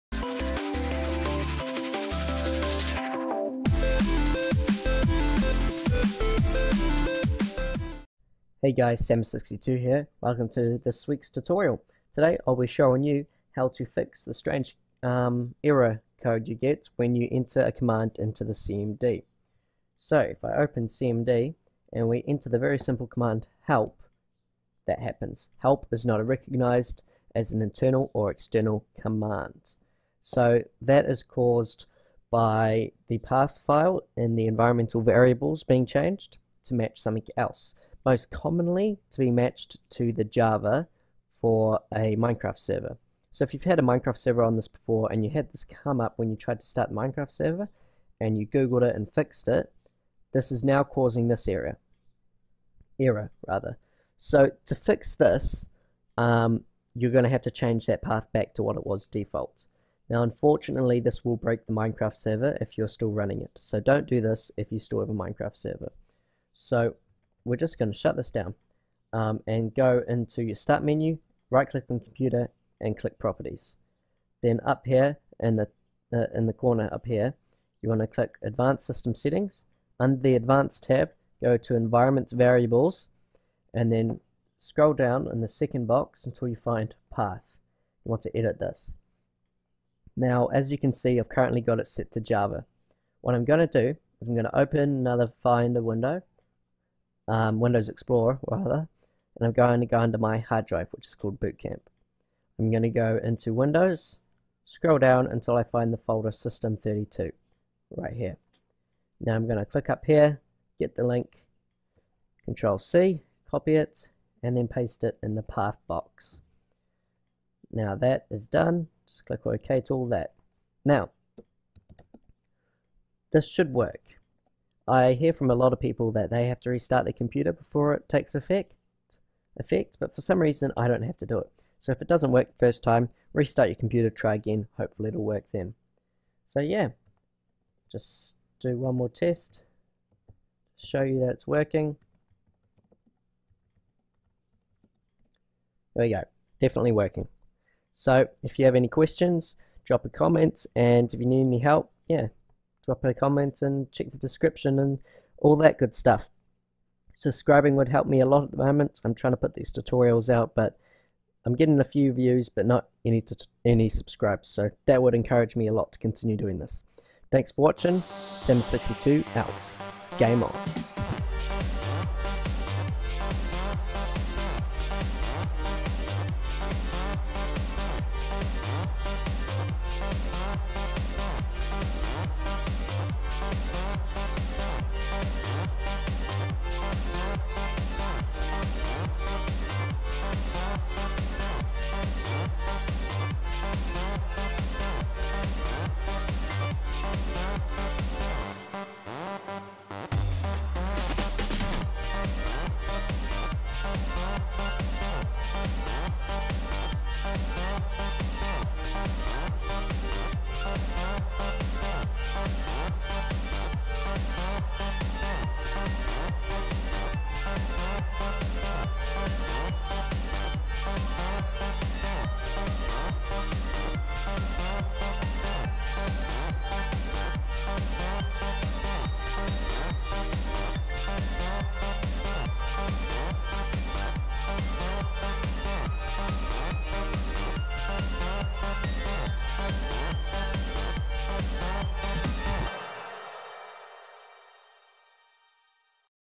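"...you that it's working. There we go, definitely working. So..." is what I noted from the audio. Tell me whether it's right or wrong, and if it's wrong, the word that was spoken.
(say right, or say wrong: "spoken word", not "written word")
right.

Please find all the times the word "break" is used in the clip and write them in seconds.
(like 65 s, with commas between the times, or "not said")
61 s.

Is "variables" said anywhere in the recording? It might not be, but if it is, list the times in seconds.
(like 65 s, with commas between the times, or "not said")
35 s, 82 s.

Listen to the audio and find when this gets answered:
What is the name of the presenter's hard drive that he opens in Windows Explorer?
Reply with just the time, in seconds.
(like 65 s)
101 s.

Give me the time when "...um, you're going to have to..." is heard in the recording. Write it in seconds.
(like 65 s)
56 s.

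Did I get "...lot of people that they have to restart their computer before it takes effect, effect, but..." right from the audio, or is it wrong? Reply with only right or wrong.
right.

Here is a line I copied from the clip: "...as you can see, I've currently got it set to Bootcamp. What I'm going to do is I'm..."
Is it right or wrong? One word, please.
wrong.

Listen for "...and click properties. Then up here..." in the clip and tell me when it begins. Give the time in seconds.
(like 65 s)
72 s.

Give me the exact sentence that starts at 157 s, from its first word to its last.
Subscribing would help me a lot at the moment.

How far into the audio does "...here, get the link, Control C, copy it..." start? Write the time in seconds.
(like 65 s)
110 s.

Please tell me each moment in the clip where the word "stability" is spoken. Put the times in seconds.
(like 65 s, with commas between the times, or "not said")
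not said.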